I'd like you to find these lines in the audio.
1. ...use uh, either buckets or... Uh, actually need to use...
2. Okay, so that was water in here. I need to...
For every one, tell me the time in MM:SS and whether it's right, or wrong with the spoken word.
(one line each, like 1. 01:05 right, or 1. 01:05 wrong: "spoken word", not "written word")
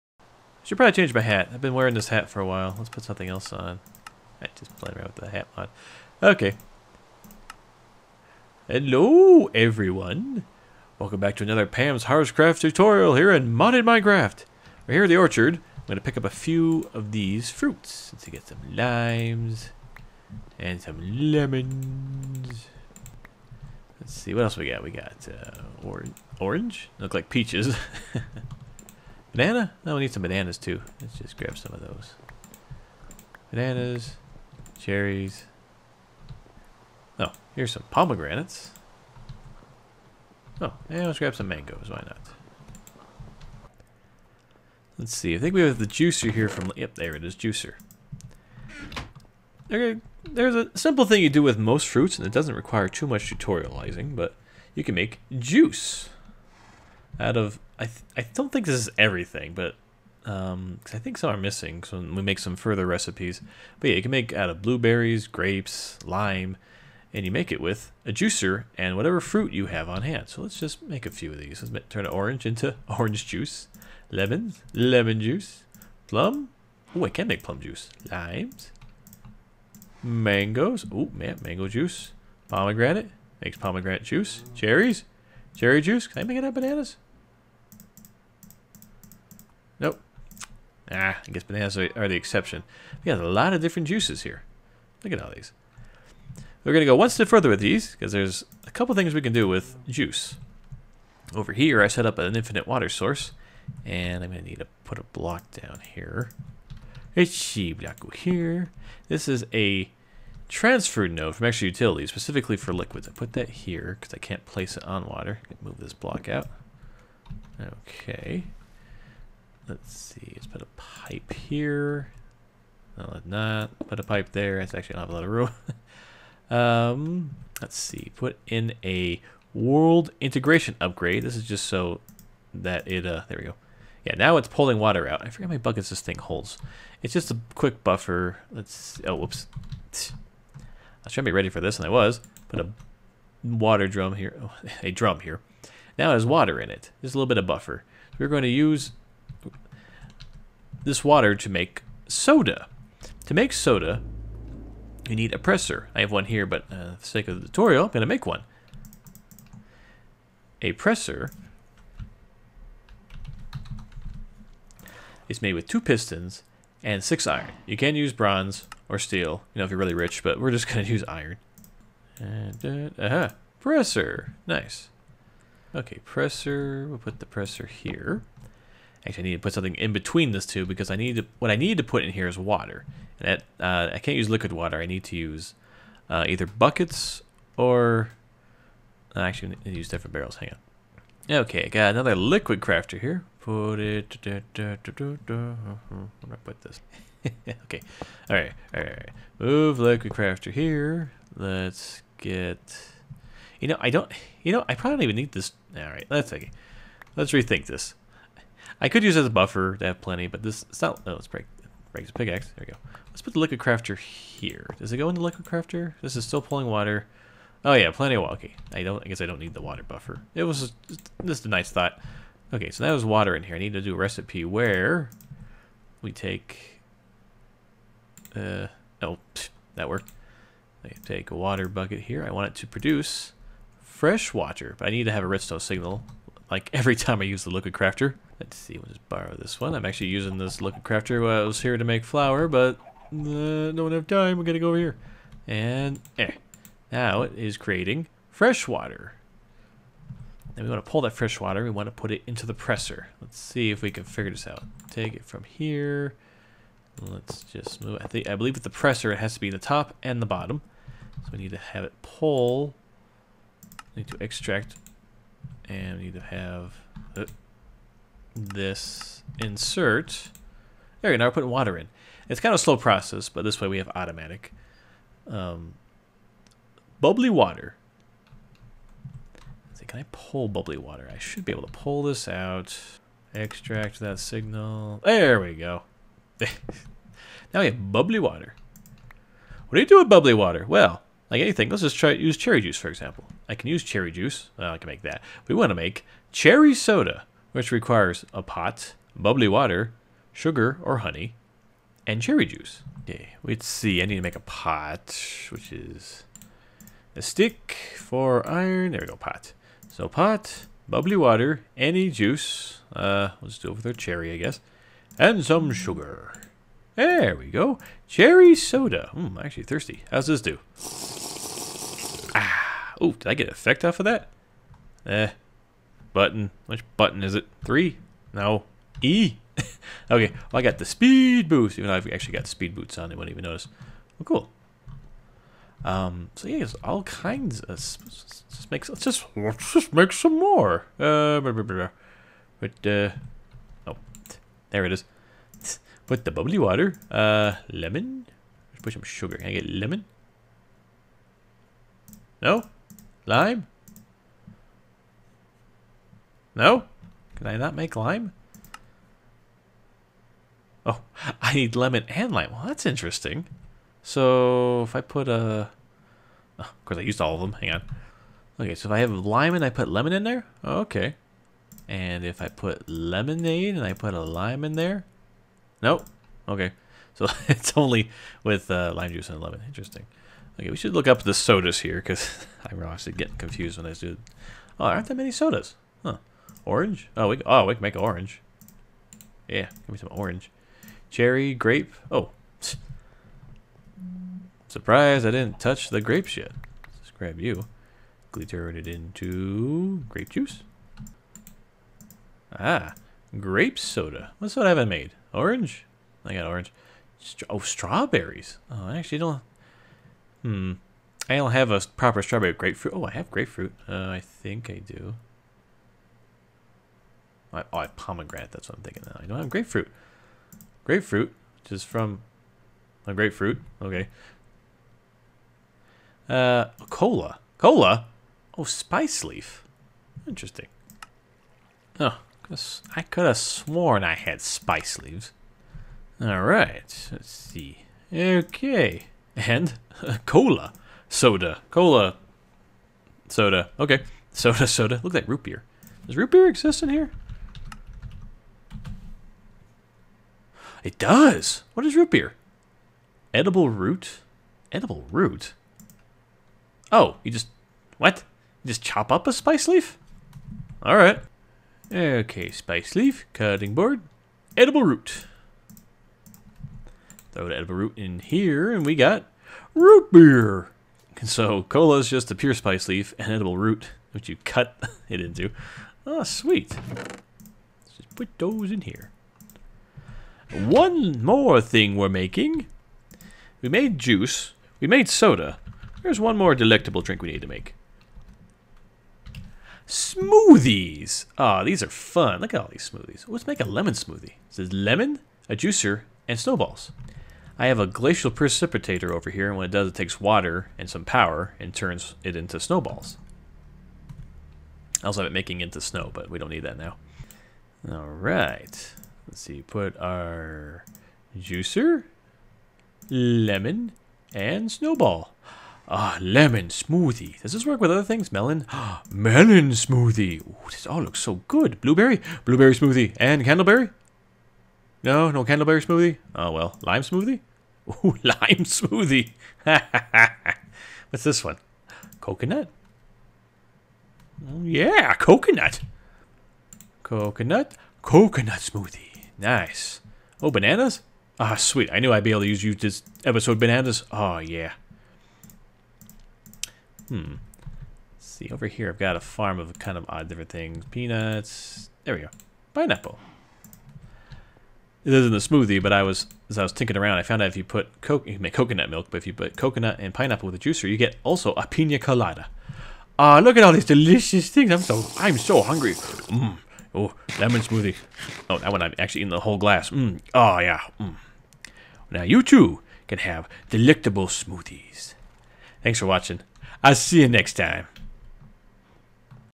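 1. 03:05 right
2. 03:42 right.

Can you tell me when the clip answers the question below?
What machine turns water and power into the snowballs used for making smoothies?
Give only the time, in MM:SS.
08:17.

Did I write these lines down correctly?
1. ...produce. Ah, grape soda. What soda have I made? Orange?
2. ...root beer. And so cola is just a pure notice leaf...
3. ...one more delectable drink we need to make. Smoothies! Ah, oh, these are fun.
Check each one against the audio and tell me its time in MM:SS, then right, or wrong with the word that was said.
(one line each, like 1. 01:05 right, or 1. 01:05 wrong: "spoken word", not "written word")
1. 06:40 wrong: "juice", not "produce"
2. 07:49 wrong: "spice", not "notice"
3. 08:06 right.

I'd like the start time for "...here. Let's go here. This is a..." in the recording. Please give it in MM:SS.
01:45.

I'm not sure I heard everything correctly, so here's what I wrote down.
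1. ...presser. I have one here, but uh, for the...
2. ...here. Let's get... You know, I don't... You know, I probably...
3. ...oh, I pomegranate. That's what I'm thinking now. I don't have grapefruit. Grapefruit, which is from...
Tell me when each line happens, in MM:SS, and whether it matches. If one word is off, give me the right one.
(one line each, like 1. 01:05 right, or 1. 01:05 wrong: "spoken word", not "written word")
1. 02:35 right
2. 03:20 right
3. 06:57 right.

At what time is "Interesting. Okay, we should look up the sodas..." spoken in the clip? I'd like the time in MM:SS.
06:19.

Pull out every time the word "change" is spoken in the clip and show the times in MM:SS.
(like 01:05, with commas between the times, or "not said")
00:00.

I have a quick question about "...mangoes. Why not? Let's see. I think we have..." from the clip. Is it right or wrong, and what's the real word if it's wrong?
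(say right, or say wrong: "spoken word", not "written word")
right.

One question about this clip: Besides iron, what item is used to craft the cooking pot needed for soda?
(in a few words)
A stick.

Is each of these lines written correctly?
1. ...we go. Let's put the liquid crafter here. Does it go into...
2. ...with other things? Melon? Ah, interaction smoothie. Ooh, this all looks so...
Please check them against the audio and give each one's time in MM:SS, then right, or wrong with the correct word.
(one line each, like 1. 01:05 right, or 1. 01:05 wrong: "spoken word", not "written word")
1. 03:32 right
2. 08:37 wrong: "melon", not "interaction".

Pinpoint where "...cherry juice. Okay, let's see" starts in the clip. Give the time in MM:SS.
05:02.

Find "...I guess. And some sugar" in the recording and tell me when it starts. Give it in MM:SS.
05:14.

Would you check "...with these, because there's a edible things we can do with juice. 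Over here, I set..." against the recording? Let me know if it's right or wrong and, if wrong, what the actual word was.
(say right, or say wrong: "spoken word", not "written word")
wrong: "couple", not "edible".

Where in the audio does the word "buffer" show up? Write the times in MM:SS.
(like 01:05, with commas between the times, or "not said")
02:17, 02:27, 03:29, 03:39.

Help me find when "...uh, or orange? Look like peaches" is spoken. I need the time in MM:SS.
00:25.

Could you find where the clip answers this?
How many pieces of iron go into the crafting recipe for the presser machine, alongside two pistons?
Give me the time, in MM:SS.
02:47.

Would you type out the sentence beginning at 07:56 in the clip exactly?
Let's just put those in here one more thing we're making.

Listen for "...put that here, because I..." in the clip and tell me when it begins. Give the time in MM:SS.
01:53.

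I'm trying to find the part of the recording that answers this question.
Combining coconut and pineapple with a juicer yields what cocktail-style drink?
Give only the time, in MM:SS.
09:21.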